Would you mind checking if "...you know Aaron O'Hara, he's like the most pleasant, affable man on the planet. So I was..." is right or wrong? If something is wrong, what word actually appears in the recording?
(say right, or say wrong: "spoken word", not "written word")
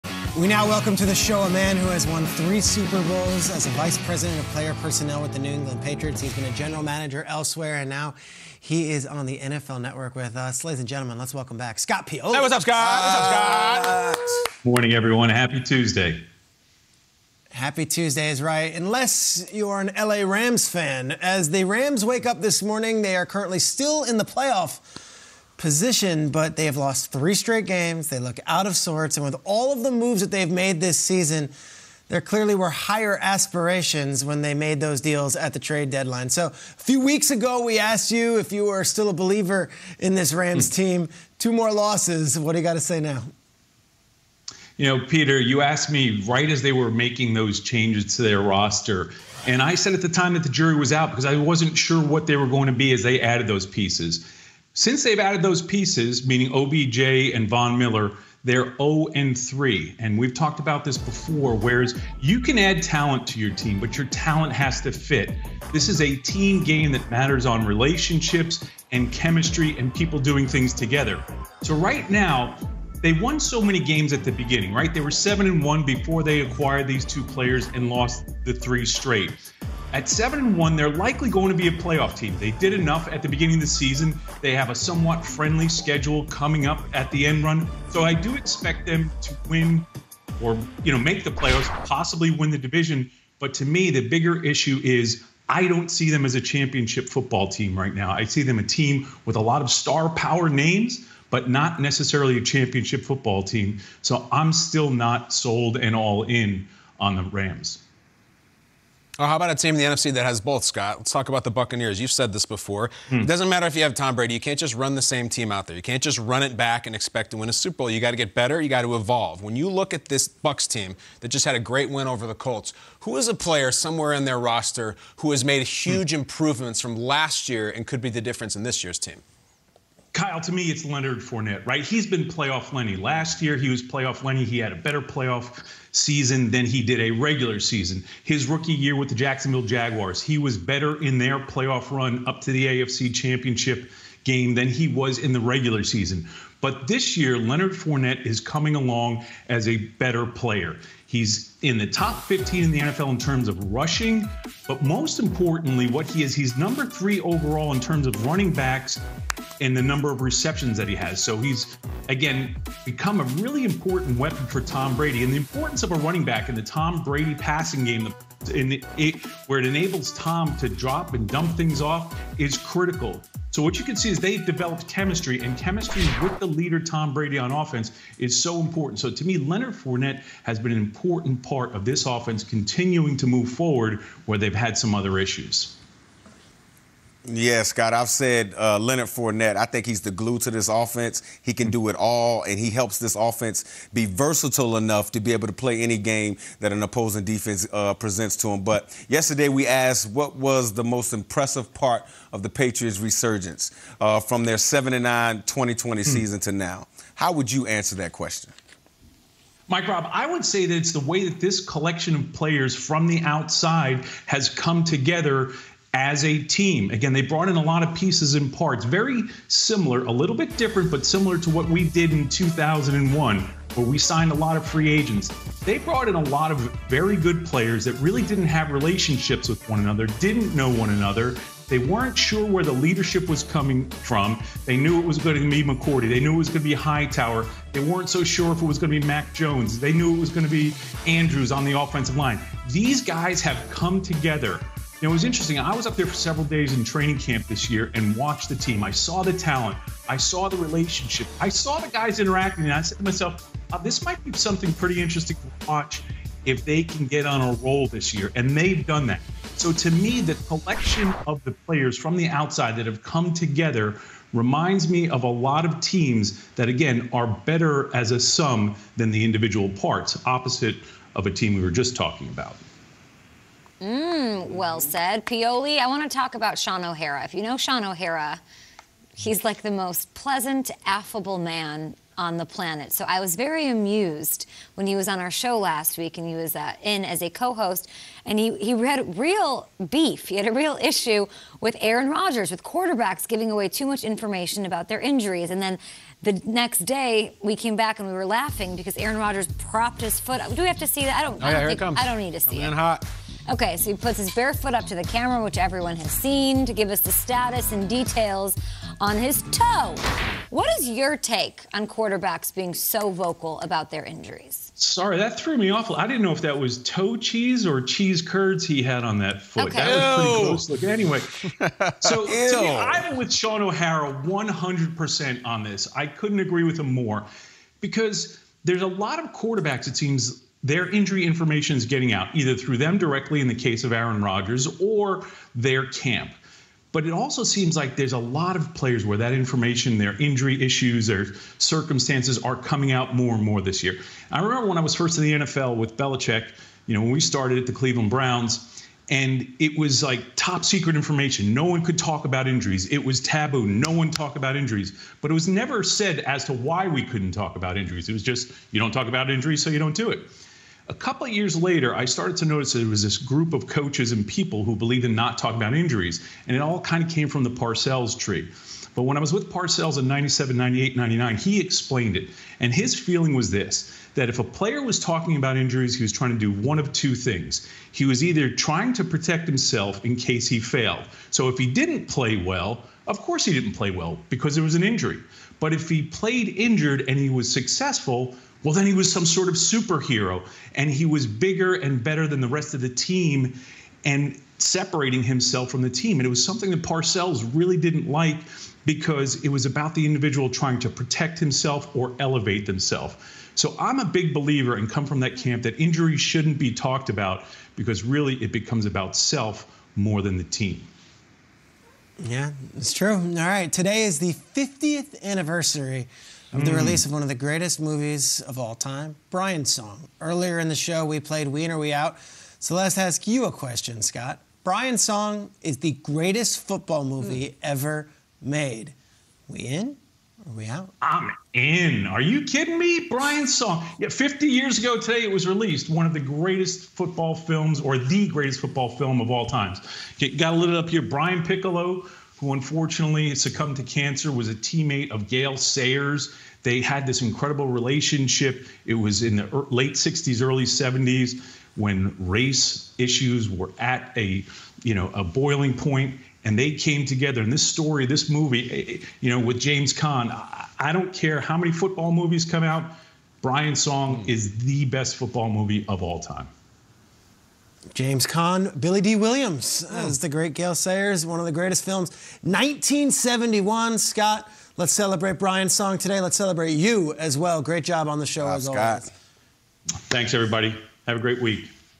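wrong: "Shaun", not "Aaron".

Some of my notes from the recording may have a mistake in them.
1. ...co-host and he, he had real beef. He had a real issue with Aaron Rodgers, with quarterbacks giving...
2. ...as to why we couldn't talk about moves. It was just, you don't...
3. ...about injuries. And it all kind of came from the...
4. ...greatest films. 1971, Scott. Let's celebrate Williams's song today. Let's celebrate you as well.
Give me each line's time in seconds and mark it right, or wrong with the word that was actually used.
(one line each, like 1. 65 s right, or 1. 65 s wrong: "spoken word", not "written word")
1. 287 s right
2. 356 s wrong: "injuries", not "moves"
3. 365 s right
4. 471 s wrong: "Brian", not "Williams".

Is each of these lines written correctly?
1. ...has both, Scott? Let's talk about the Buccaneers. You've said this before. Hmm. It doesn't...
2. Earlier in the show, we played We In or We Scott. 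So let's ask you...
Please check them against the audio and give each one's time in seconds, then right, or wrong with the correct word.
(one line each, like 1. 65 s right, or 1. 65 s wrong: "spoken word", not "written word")
1. 110 s right
2. 420 s wrong: "Out", not "Scott".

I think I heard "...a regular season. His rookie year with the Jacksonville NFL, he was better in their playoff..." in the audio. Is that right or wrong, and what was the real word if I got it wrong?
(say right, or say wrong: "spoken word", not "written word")
wrong: "Jaguars", not "NFL".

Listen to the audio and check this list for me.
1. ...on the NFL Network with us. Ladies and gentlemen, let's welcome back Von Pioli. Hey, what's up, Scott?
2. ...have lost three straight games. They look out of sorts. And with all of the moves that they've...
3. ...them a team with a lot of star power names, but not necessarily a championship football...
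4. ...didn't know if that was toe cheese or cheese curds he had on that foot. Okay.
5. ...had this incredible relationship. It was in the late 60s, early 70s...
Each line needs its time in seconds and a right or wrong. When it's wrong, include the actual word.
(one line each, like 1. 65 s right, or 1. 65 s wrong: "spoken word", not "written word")
1. 9 s wrong: "Scott", not "Von"
2. 26 s right
3. 98 s right
4. 316 s right
5. 446 s right.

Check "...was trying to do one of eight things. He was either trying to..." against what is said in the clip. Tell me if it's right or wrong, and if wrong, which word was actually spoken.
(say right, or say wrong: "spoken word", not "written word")
wrong: "two", not "eight".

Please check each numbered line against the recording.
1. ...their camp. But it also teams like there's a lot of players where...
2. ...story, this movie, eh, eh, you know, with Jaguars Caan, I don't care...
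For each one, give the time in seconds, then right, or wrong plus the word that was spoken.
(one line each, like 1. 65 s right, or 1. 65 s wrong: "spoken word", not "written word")
1. 335 s wrong: "seems", not "teams"
2. 457 s wrong: "James", not "Jaguars".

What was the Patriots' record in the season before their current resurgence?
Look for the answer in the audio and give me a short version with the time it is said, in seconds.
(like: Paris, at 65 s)
7-9, at 204 s.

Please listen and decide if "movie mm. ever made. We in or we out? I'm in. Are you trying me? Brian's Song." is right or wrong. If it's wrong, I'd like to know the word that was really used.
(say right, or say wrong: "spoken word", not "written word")
wrong: "kidding", not "trying".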